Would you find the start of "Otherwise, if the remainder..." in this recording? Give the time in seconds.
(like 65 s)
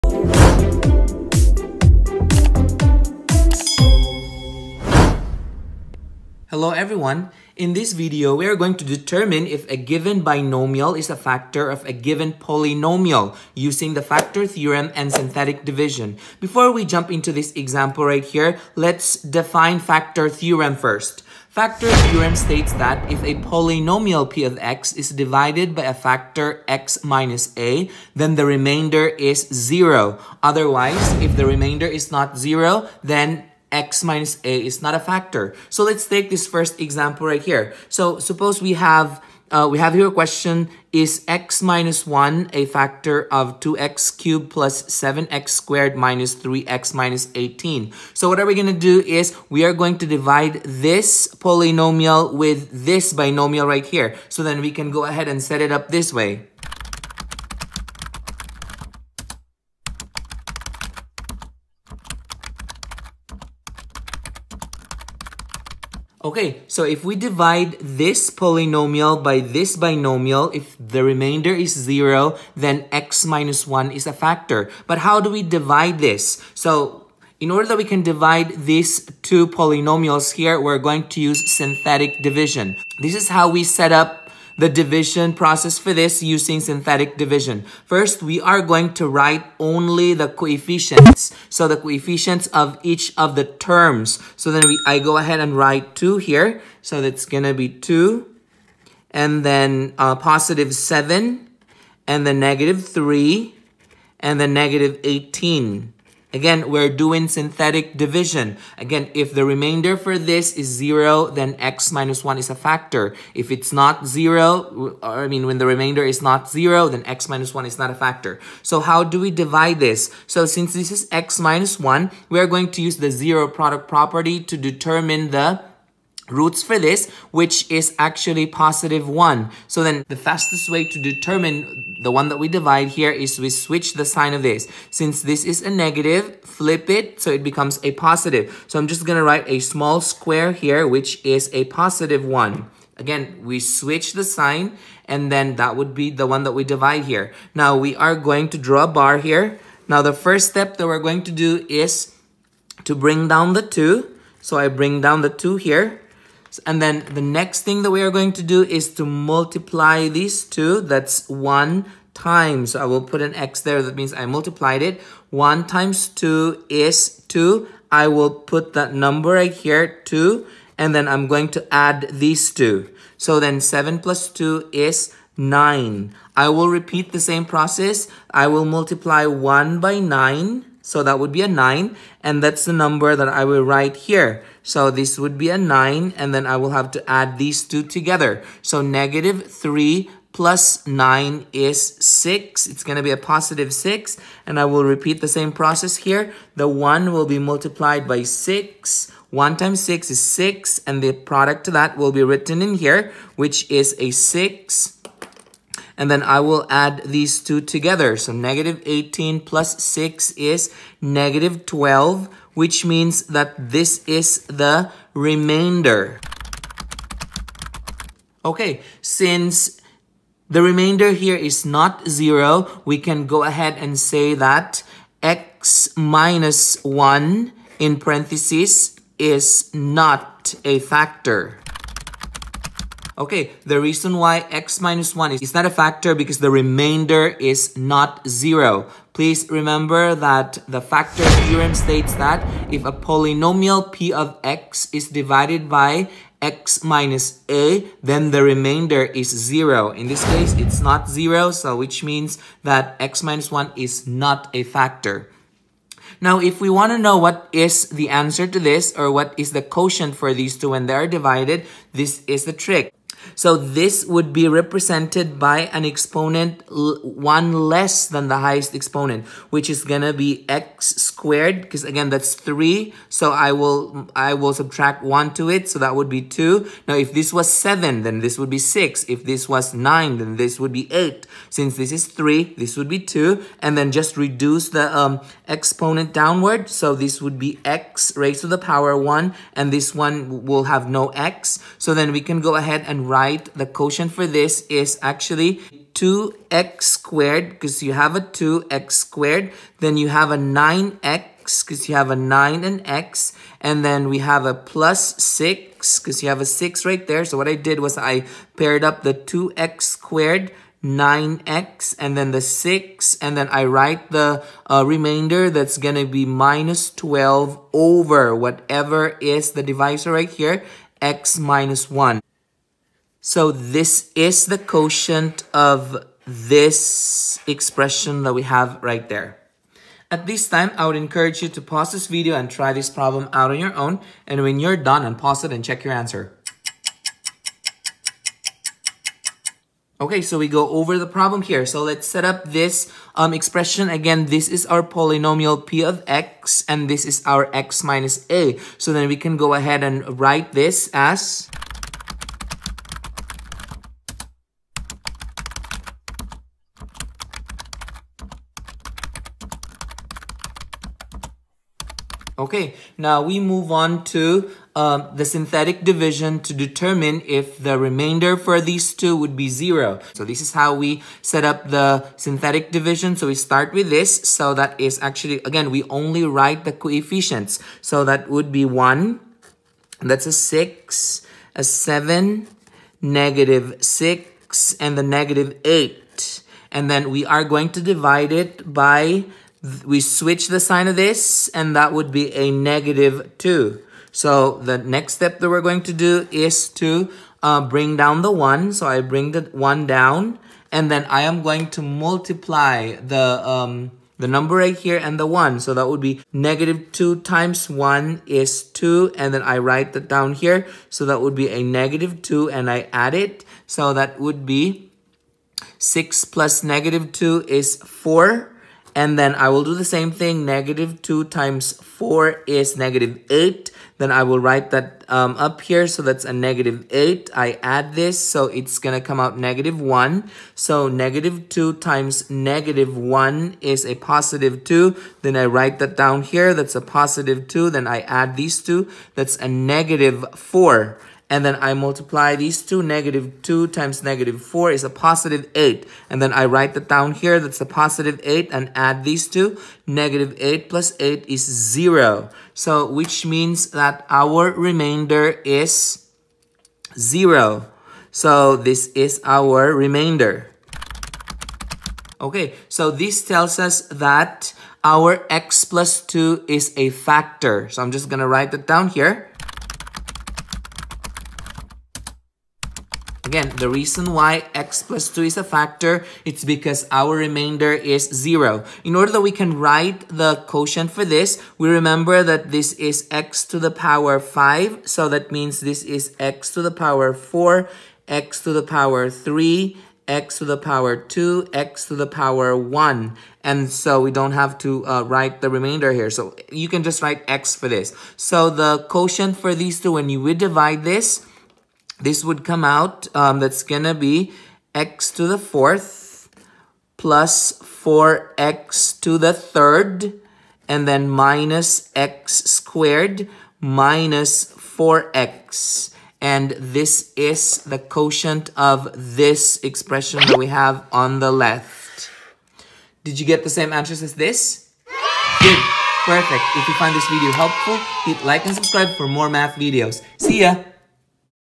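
30 s.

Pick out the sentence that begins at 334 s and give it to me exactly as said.
And when you're done, and pause it and check your answer.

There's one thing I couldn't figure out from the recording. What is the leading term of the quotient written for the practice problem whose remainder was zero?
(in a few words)
x^4.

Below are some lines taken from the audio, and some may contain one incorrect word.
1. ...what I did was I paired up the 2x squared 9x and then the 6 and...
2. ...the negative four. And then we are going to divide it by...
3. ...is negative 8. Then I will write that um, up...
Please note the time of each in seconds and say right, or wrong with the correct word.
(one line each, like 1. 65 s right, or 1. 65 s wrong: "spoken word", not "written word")
1. 307 s right
2. 384 s wrong: "eight", not "four"
3. 422 s right.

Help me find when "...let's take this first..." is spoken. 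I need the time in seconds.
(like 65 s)
35 s.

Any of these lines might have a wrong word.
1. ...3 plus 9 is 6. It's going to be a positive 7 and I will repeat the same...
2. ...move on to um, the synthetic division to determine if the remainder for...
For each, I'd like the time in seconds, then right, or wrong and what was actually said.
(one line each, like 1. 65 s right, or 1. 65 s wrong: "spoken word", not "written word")
1. 189 s wrong: "6", not "7"
2. 363 s right.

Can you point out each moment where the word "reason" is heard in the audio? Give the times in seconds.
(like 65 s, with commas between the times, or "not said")
233 s, 473 s.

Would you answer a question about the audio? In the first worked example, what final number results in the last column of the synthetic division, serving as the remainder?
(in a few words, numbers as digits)
-12.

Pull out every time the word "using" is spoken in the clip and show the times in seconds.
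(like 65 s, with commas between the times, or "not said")
13 s, 86 s.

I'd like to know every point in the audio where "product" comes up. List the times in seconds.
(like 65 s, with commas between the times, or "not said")
123 s, 201 s.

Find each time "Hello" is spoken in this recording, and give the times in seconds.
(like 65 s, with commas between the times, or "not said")
6 s.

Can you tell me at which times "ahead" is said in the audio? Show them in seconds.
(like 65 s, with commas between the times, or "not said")
55 s, 95 s, 223 s, 292 s, 349 s.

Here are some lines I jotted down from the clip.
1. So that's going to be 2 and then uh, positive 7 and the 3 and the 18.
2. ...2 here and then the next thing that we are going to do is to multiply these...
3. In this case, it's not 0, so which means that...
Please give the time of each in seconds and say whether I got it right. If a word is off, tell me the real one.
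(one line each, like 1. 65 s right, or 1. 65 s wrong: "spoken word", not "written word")
1. 96 s right
2. 155 s right
3. 249 s right.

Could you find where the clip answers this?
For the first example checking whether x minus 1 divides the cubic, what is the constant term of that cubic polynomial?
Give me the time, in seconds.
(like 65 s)
46 s.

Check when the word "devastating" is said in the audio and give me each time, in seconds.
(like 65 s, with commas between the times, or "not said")
not said.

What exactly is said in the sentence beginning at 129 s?
So then the fastest way to determine the one that we divide here is we switch the sign of this.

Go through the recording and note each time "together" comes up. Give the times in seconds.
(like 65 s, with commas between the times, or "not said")
187 s, 207 s.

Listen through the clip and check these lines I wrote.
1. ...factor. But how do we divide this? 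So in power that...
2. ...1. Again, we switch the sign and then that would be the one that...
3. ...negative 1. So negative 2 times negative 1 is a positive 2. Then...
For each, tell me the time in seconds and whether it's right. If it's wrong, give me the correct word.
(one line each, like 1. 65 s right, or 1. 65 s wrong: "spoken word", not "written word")
1. 74 s wrong: "order", not "power"
2. 142 s right
3. 429 s right.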